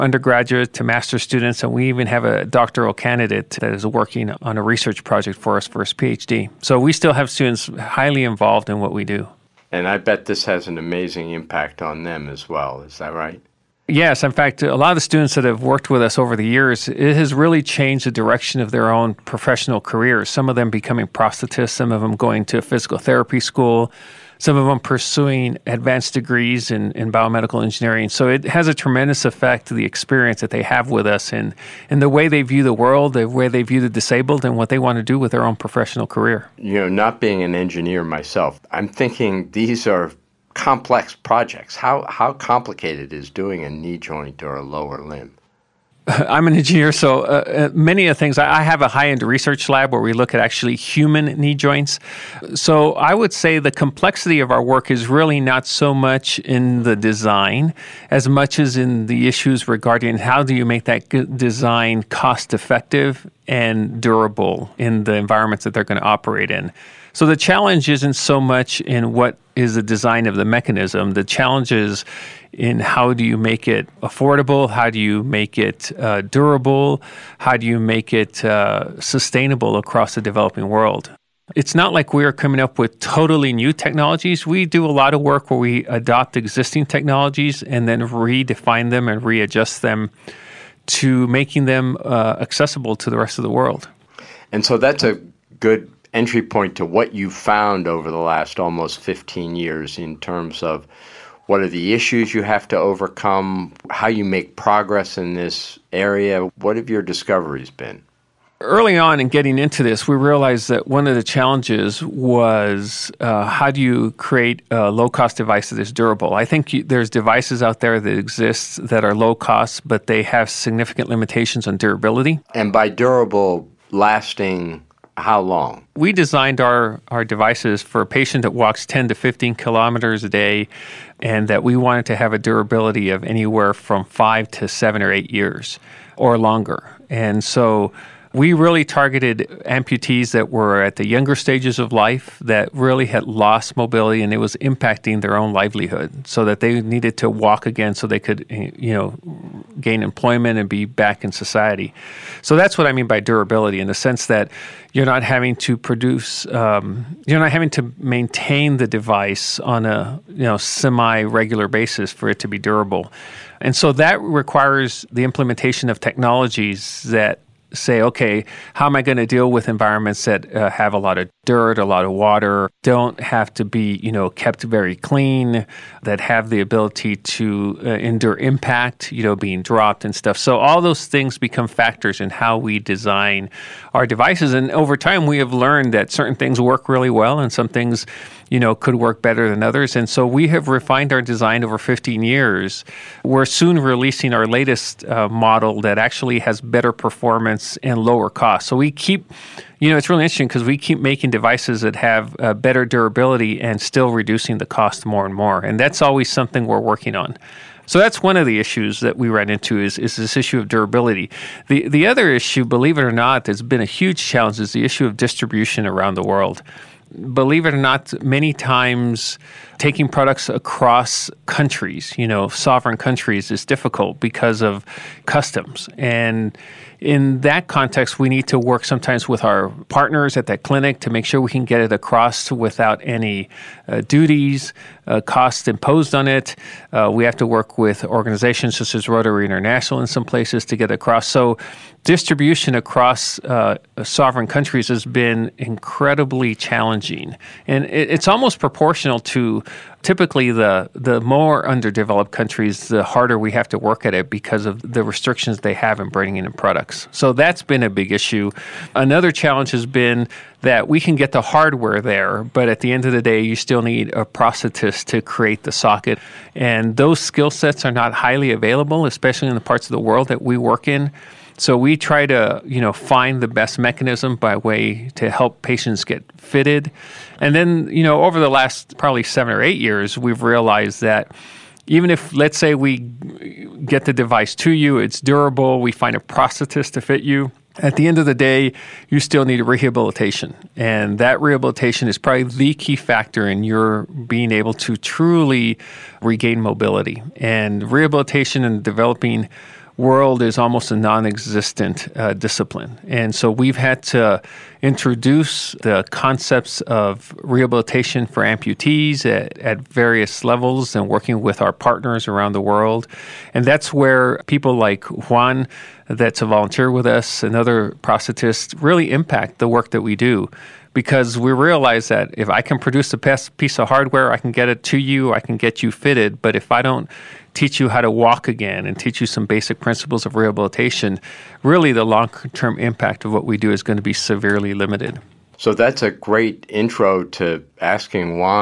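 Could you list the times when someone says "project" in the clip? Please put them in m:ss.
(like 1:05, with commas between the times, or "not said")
0:05, 0:41.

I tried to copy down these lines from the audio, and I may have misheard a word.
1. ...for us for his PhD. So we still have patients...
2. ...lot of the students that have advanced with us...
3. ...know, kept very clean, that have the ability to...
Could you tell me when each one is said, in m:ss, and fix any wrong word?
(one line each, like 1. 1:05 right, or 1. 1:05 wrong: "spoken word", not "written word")
1. 0:05 wrong: "students", not "patients"
2. 0:14 wrong: "worked", not "advanced"
3. 2:54 right.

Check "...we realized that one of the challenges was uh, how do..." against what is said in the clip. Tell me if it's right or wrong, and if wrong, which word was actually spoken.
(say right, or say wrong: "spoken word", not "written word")
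right.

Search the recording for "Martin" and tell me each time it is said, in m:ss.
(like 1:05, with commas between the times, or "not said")
not said.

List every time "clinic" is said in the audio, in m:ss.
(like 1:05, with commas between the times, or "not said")
3:50.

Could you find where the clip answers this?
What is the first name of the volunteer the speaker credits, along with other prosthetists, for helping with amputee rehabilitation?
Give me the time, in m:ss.
5:15.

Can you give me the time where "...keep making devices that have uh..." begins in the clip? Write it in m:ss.
3:20.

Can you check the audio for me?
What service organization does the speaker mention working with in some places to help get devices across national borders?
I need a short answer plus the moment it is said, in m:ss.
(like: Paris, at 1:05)
Rotary International, at 3:59.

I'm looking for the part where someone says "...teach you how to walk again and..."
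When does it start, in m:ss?
5:27.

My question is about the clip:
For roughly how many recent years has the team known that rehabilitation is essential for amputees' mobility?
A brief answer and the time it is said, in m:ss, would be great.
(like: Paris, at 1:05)
7 or 8, at 4:39.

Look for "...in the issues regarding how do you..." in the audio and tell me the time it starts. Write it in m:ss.
0:58.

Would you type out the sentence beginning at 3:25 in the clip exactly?
And that's always something we're working on.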